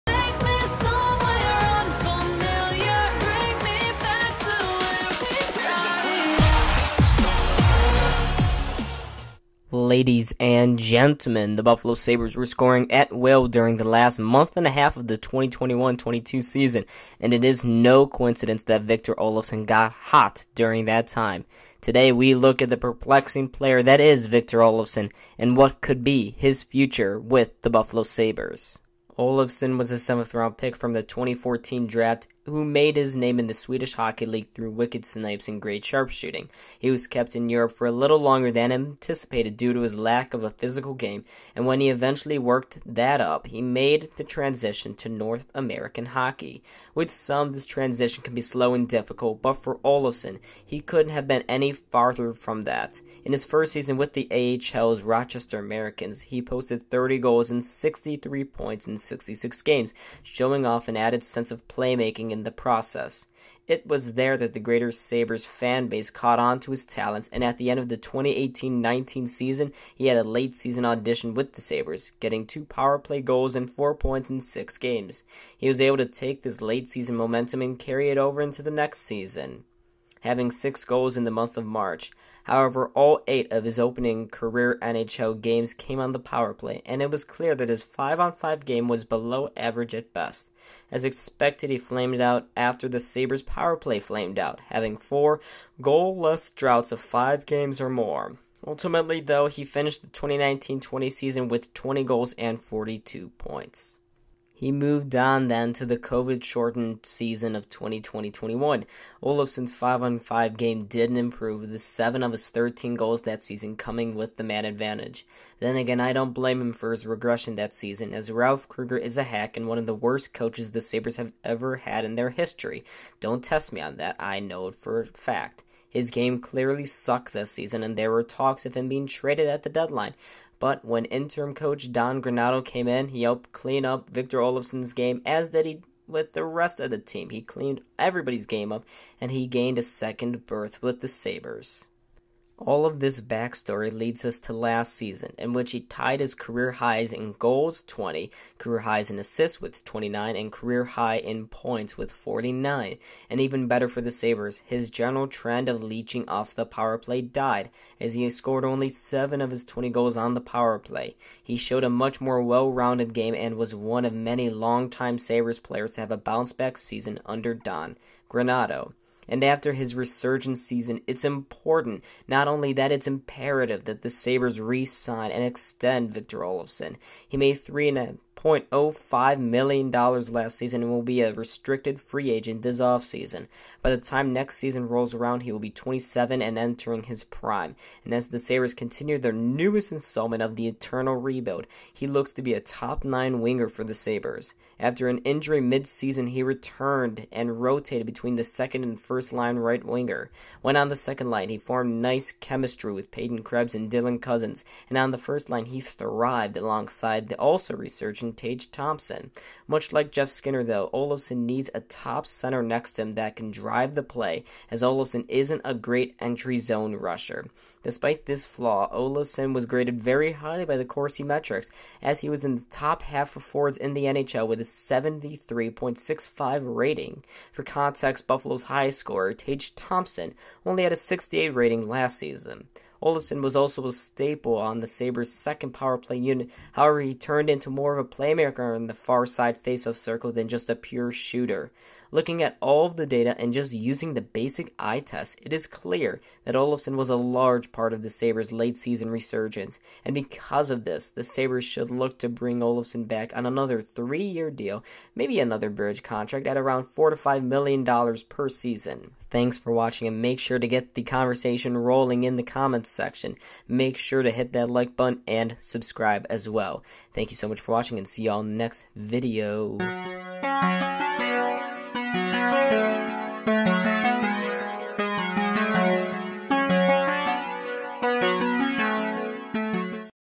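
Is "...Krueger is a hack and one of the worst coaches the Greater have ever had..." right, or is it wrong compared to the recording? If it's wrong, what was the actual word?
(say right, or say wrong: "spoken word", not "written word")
wrong: "Sabres", not "Greater".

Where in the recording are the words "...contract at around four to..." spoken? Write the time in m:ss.
4:16.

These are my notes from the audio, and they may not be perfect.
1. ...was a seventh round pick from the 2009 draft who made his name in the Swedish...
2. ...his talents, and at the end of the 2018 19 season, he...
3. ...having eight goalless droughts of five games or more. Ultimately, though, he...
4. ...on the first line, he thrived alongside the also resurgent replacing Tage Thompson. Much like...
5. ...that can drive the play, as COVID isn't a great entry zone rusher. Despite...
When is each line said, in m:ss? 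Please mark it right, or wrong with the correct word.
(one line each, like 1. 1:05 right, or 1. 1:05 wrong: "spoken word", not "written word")
1. 0:29 wrong: "2014", not "2009"
2. 1:06 right
3. 1:34 wrong: "four", not "eight"
4. 3:24 right
5. 3:33 wrong: "Olofsson", not "COVID".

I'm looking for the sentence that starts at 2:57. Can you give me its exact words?
He made three and a $6.05 million last season and will be a restricted free agent this offseason.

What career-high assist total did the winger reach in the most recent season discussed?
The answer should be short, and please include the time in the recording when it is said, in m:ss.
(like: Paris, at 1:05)
29, at 2:29.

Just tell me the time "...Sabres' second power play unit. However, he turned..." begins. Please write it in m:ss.
3:54.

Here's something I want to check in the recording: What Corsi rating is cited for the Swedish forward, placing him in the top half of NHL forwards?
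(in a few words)
73.65.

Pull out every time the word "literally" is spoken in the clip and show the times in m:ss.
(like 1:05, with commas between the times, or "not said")
not said.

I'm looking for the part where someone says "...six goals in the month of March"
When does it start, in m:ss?
1:20.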